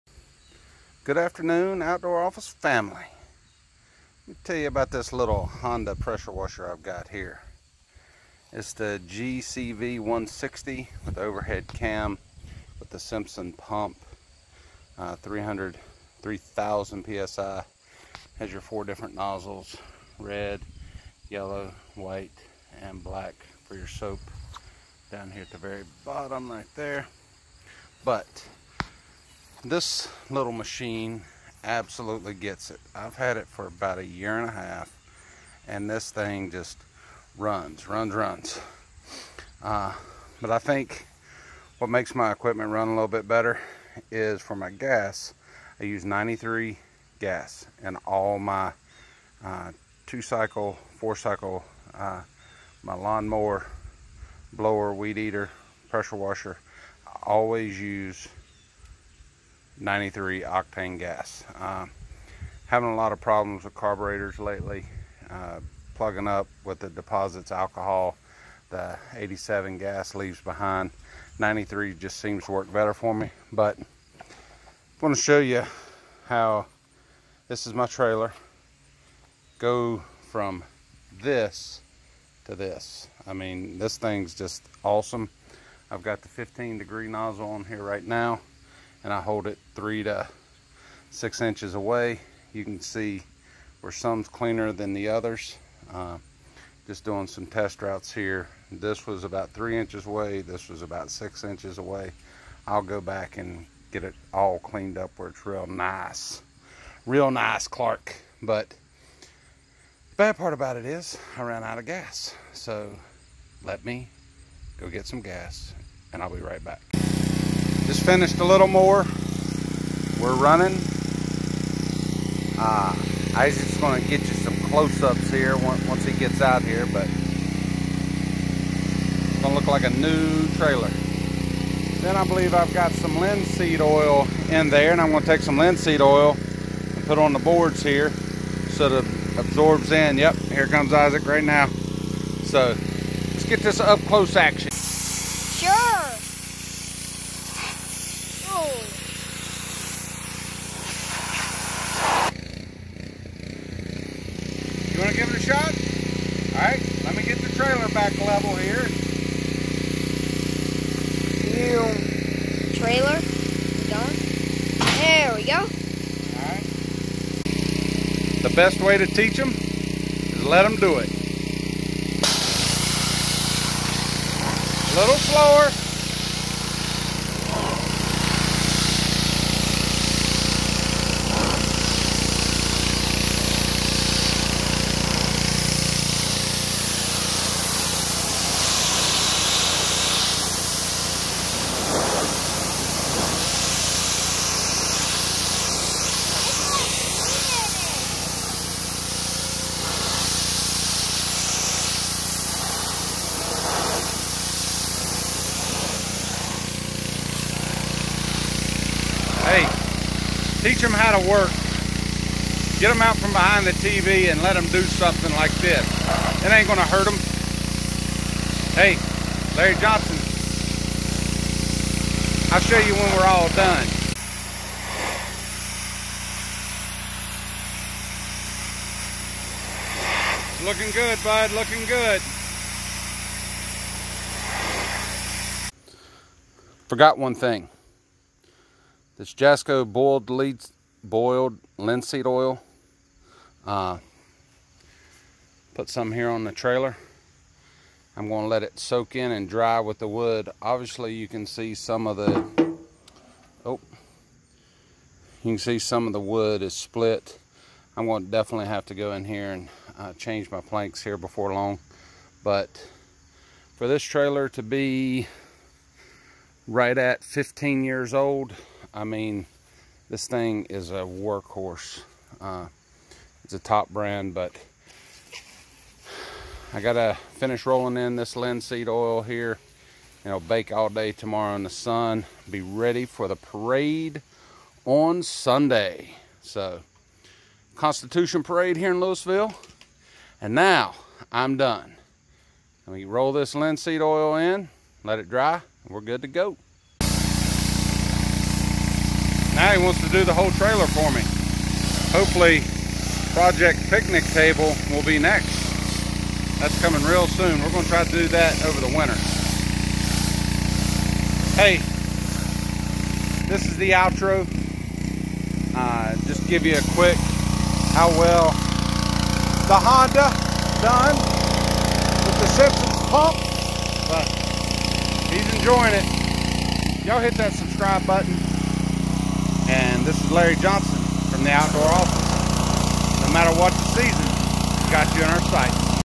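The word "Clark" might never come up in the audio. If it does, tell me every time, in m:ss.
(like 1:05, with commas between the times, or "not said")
1:47.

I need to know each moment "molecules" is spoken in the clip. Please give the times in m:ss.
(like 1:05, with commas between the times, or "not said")
not said.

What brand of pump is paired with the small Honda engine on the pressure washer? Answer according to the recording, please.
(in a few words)
Simpson.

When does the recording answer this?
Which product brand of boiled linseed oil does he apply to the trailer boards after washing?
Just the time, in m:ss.
3:59.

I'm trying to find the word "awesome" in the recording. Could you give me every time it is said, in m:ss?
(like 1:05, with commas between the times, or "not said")
1:24.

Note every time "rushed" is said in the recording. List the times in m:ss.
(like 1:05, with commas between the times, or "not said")
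not said.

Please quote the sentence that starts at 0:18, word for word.
Has your four different nozzles, red, yellow, white, and black for your soap.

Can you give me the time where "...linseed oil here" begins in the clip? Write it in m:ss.
4:38.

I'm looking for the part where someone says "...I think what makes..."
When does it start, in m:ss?
0:40.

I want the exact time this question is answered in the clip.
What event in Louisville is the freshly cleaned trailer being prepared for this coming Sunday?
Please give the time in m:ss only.
4:47.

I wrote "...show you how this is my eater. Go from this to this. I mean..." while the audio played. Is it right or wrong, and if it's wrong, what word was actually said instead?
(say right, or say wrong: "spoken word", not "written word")
wrong: "trailer", not "eater".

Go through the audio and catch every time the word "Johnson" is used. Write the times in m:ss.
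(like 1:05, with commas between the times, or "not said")
3:39, 5:30.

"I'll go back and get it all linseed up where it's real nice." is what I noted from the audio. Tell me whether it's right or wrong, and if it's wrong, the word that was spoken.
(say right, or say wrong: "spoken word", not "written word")
wrong: "cleaned", not "linseed".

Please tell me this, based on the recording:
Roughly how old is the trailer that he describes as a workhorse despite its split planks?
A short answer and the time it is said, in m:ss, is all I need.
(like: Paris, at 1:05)
15 years, at 4:27.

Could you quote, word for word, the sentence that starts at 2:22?
So let's get this up close action.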